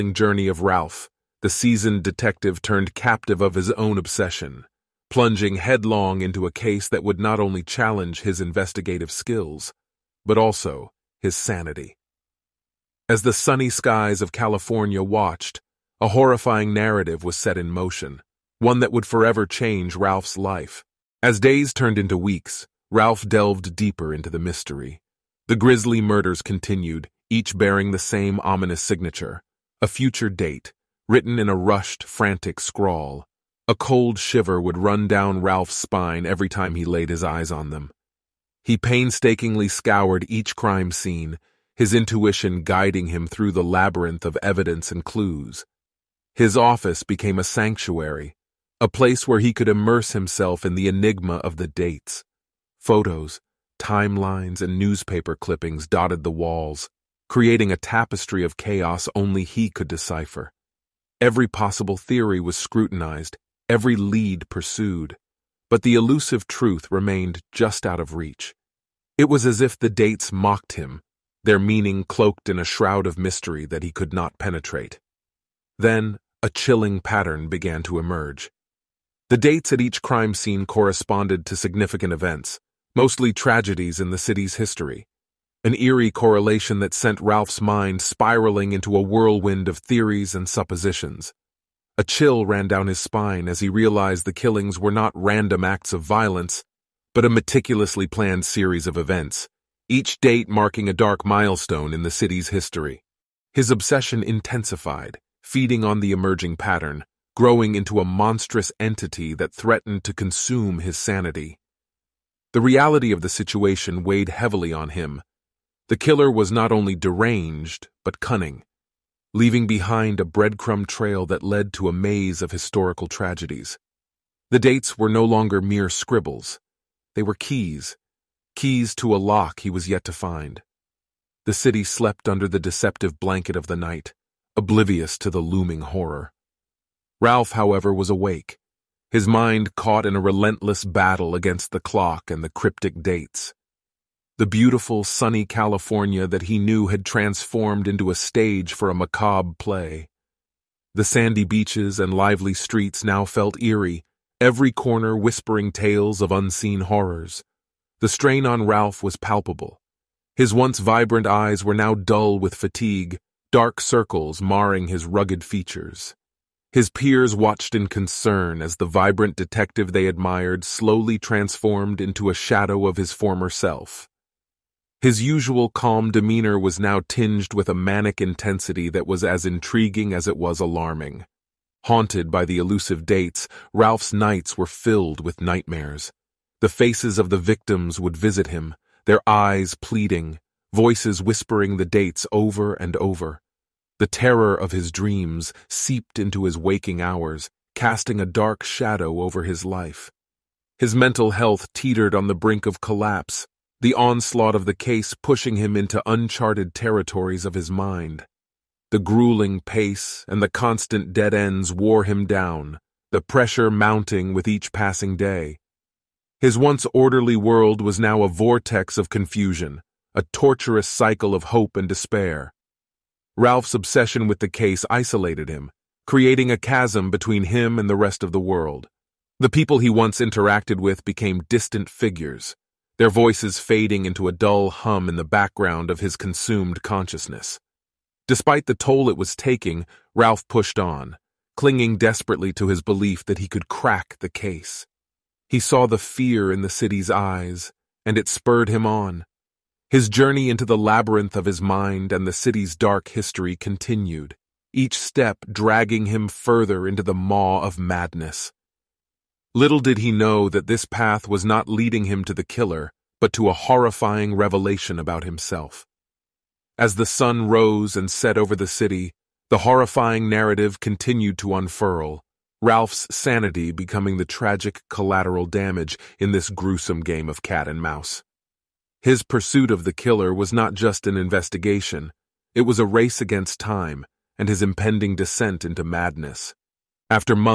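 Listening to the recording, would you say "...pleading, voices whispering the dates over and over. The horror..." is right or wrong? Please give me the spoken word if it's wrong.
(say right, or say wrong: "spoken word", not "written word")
wrong: "terror", not "horror".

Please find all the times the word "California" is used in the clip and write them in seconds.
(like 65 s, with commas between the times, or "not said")
14 s, 145 s.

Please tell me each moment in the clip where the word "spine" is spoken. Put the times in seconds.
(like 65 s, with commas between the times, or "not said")
35 s, 92 s.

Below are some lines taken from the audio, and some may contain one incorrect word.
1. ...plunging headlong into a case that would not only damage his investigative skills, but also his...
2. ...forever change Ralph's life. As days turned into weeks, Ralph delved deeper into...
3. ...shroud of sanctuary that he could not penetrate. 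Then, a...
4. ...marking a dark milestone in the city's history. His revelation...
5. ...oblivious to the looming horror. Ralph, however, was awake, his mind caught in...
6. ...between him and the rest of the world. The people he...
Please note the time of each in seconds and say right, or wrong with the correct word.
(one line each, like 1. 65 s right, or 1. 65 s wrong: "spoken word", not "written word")
1. 5 s wrong: "challenge", not "damage"
2. 19 s right
3. 72 s wrong: "mystery", not "sanctuary"
4. 100 s wrong: "obsession", not "revelation"
5. 134 s right
6. 227 s right.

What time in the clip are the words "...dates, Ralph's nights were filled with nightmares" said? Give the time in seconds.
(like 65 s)
183 s.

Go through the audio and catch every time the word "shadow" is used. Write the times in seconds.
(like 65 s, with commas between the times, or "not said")
172 s, 198 s.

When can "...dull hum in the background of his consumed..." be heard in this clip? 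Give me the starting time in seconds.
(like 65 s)
234 s.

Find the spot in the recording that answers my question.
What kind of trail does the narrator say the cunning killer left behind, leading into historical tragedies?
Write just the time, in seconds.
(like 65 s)
120 s.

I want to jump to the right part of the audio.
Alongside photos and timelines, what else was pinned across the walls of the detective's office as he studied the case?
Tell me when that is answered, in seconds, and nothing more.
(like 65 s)
54 s.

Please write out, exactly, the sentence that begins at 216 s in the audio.
His once orderly world was now a vortex of confusion, a torturous cycle of hope and despair.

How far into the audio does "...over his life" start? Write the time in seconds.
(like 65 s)
199 s.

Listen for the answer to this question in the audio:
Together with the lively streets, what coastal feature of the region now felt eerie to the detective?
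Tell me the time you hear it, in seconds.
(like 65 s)
151 s.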